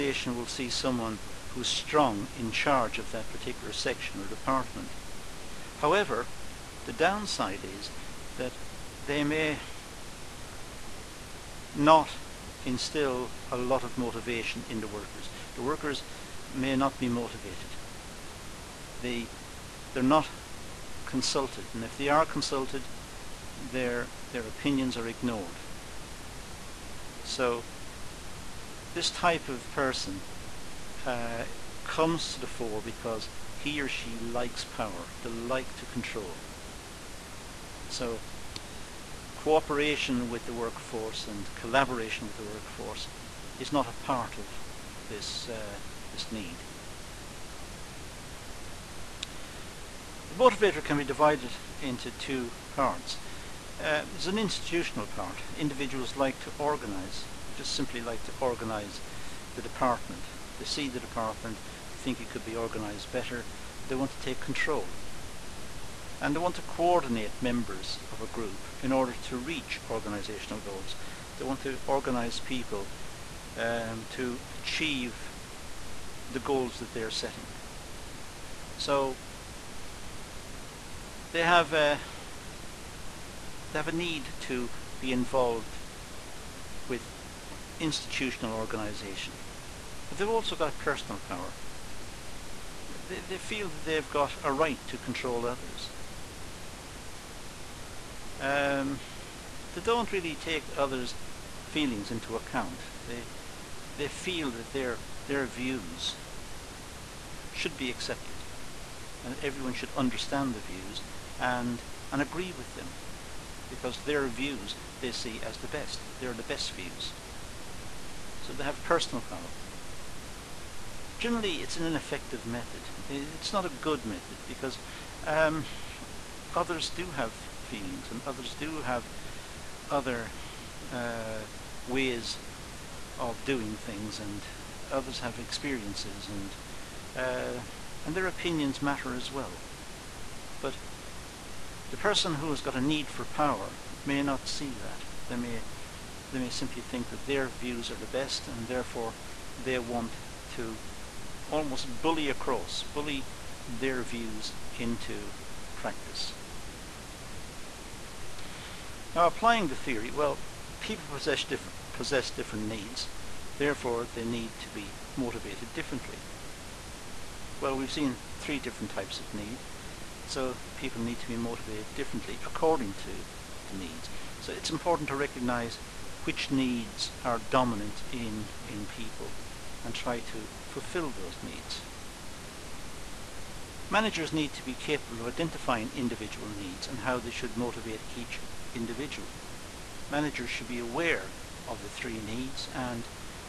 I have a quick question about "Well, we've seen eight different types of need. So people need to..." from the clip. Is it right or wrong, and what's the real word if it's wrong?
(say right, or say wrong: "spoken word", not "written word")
wrong: "three", not "eight".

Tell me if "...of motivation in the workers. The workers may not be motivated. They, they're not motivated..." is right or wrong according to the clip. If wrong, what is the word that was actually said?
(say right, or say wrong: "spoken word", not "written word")
wrong: "consulted", not "motivated".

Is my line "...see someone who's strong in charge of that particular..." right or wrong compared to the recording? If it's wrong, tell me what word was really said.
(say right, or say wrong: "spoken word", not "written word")
right.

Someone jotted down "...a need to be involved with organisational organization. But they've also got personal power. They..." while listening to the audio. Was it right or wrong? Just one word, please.
wrong.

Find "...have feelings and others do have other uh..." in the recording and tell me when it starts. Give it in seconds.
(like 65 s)
127 s.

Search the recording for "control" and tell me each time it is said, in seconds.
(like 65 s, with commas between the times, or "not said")
35 s, 64 s, 94 s.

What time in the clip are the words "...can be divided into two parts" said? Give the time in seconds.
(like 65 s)
50 s.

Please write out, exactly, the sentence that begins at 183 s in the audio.
Managers need to be capable of identifying individual needs and how they should motivate each individual.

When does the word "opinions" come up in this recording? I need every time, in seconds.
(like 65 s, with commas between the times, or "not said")
24 s, 138 s.